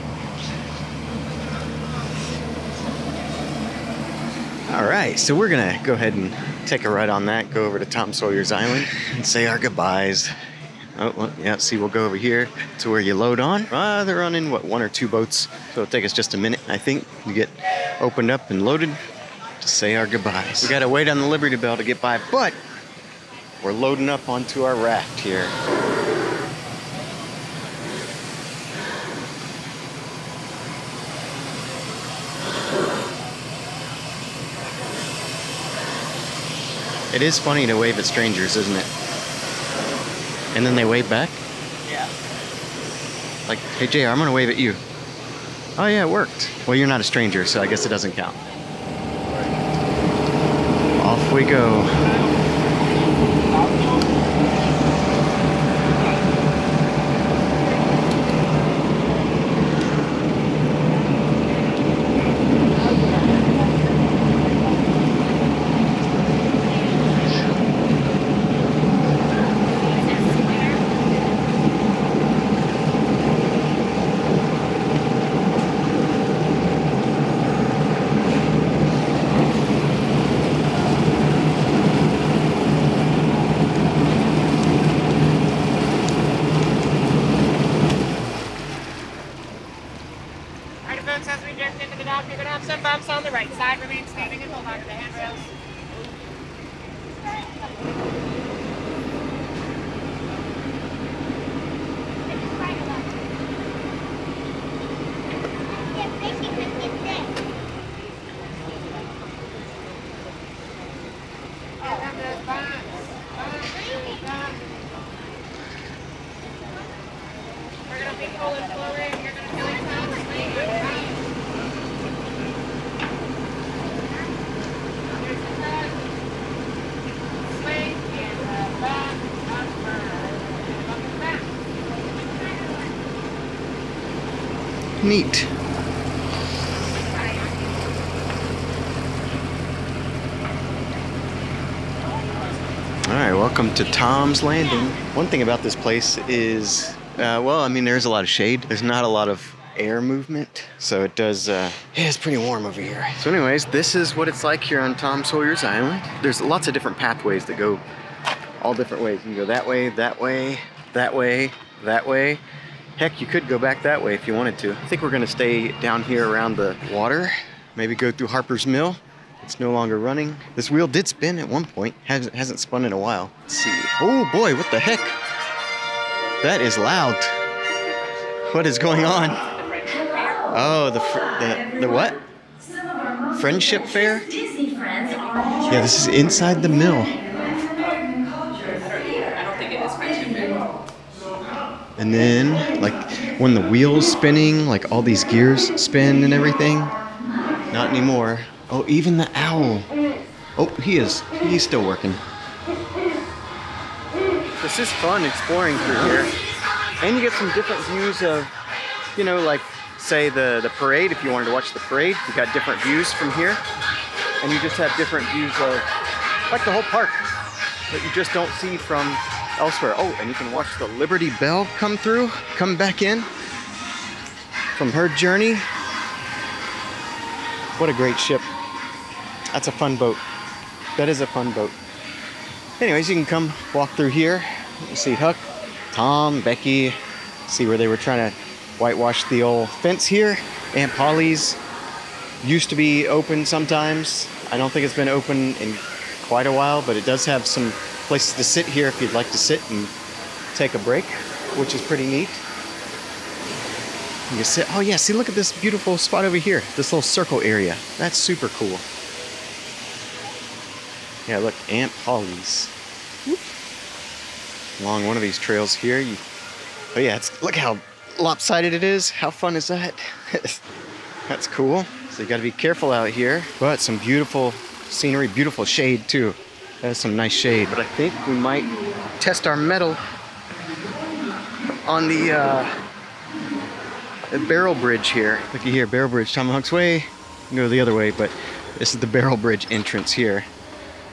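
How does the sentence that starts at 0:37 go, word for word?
It is funny to wave at strangers, isn't it?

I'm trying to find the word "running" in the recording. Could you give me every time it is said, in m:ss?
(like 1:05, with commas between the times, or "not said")
0:14, 2:49.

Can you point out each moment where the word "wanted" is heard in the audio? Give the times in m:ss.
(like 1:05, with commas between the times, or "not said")
2:44, 3:31.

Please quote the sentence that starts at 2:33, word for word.
So anyways, this is what it's like here on Tom Sawyer's Island.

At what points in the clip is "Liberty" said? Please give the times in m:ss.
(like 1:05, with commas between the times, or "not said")
0:21, 3:40.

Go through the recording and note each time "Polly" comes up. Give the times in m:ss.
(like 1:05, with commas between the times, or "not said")
4:00, 4:22.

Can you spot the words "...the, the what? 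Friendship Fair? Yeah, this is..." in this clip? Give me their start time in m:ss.
3:01.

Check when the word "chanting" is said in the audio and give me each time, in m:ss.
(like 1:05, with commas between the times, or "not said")
not said.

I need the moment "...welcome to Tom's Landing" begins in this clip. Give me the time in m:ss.
2:23.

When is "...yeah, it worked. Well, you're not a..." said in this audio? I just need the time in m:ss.
0:45.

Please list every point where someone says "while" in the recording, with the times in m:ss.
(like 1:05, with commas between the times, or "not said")
2:52, 4:06.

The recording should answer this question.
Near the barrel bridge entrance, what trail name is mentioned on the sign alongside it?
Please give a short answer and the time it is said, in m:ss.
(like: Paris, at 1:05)
Tomahawk's Way, at 4:46.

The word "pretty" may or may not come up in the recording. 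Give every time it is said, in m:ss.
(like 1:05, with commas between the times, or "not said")
2:32, 4:11.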